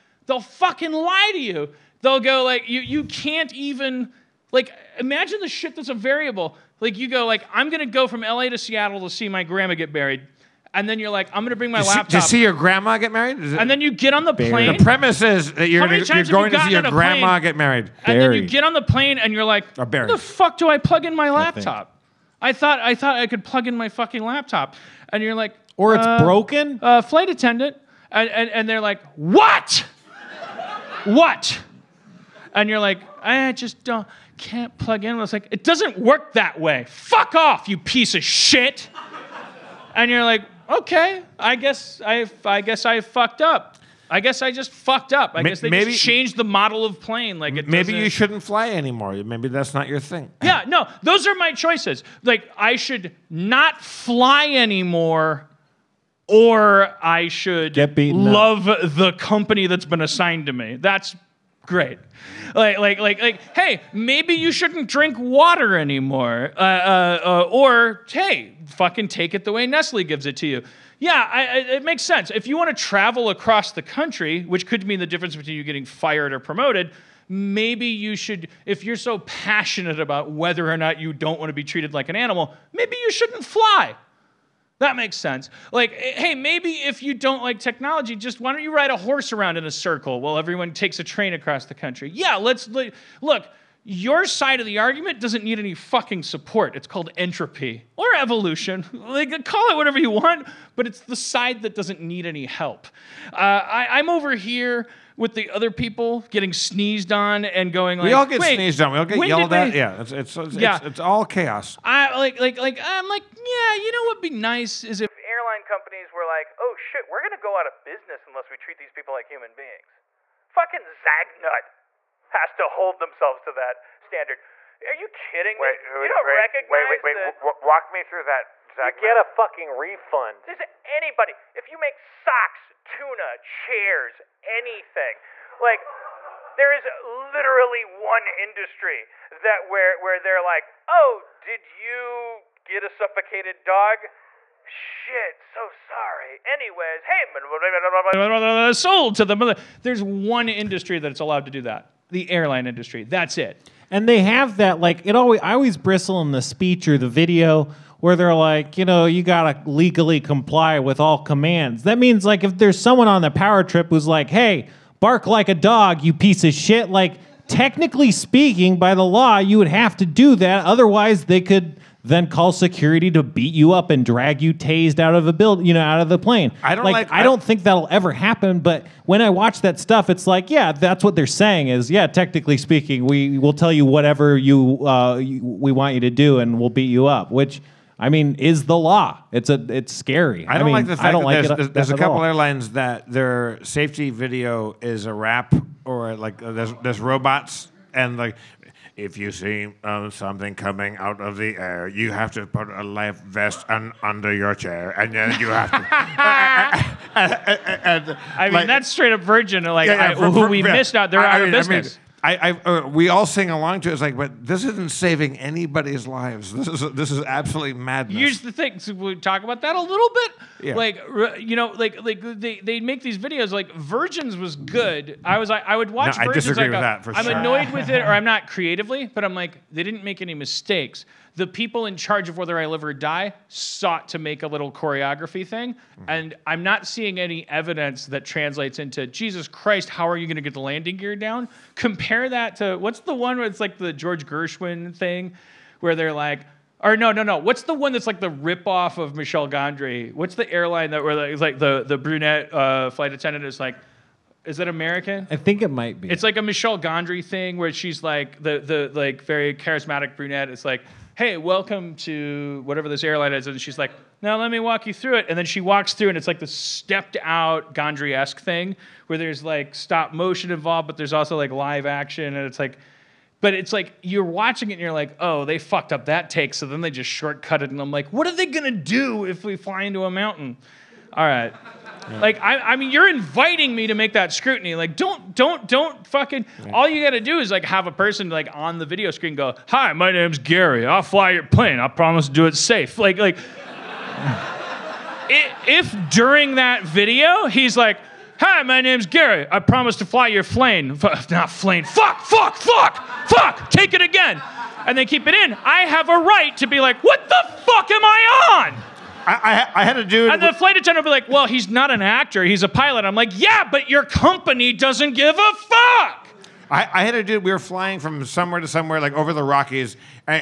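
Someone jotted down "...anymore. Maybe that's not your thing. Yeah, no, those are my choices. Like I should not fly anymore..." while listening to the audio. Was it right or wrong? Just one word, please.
right.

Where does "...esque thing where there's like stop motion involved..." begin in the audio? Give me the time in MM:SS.
04:28.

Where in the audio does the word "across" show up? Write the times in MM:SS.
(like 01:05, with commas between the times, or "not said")
01:13, 01:31.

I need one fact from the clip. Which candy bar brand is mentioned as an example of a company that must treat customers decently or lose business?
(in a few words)
Zagnut.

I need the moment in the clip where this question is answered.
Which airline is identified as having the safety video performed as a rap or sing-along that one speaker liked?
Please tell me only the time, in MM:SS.
03:29.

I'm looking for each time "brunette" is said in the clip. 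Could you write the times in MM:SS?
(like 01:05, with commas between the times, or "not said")
04:11, 04:20.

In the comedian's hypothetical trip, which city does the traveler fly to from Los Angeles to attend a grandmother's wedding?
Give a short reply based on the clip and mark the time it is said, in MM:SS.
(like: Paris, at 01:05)
Seattle, at 00:08.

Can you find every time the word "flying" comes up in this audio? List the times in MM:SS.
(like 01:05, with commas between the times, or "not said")
05:17.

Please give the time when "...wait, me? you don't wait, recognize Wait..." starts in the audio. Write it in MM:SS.
02:05.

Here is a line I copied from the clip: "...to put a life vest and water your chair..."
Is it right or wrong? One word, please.
wrong.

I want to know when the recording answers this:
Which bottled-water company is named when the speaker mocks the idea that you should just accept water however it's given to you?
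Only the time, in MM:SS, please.
01:09.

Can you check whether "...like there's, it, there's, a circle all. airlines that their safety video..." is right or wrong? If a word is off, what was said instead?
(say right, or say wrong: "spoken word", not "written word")
wrong: "couple", not "circle".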